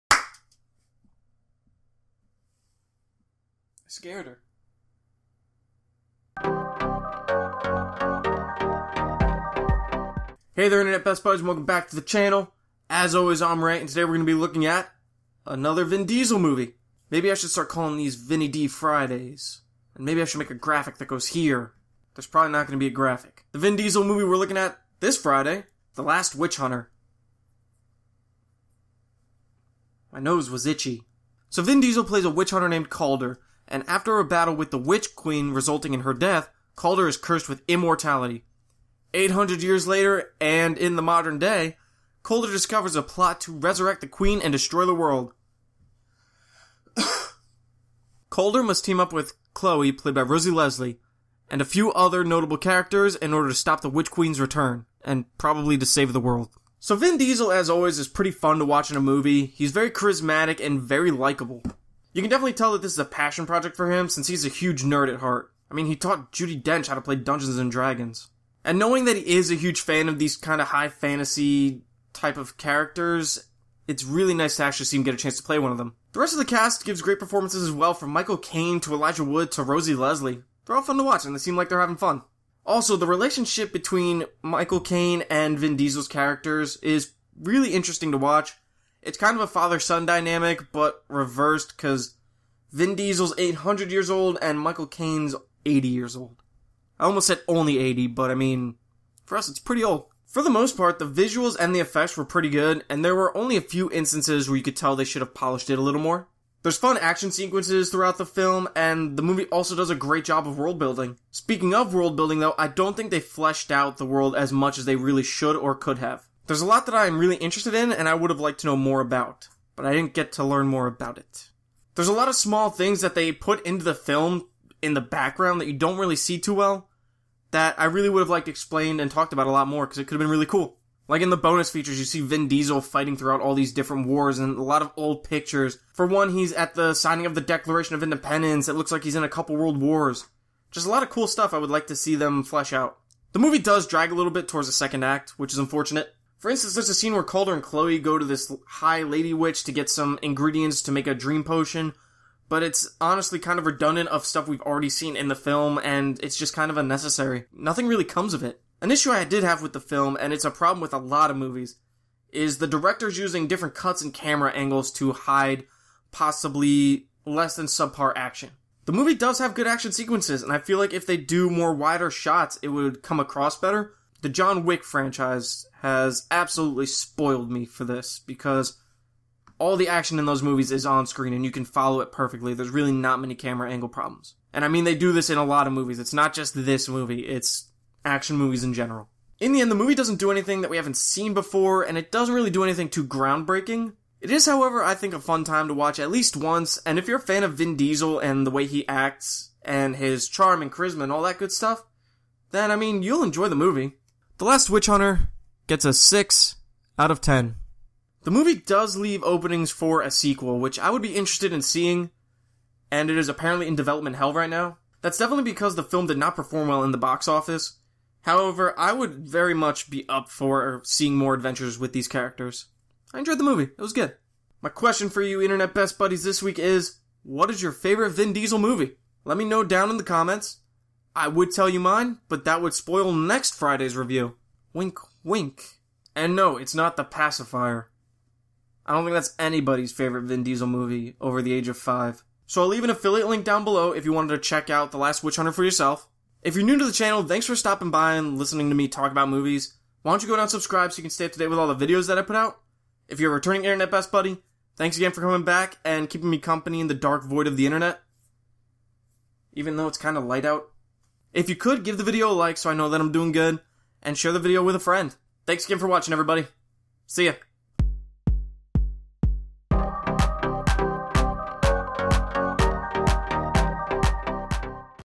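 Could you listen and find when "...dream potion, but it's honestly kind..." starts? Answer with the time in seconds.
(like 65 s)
151 s.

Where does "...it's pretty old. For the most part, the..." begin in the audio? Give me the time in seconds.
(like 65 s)
99 s.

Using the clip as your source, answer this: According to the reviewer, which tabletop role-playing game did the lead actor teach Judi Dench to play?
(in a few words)
Dungeons and Dragons.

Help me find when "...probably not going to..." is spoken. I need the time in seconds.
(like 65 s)
22 s.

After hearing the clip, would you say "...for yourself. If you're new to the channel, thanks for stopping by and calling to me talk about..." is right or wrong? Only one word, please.
wrong.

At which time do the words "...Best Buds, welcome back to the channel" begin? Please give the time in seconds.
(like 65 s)
11 s.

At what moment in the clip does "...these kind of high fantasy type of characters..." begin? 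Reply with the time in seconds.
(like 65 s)
70 s.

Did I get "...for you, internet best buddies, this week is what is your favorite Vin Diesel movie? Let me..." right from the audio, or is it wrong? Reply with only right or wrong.
right.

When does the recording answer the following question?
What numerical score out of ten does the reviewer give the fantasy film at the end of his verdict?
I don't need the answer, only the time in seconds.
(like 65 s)
205 s.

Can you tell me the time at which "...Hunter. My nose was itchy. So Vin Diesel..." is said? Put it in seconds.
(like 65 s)
26 s.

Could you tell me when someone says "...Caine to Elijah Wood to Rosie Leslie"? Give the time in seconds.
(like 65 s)
78 s.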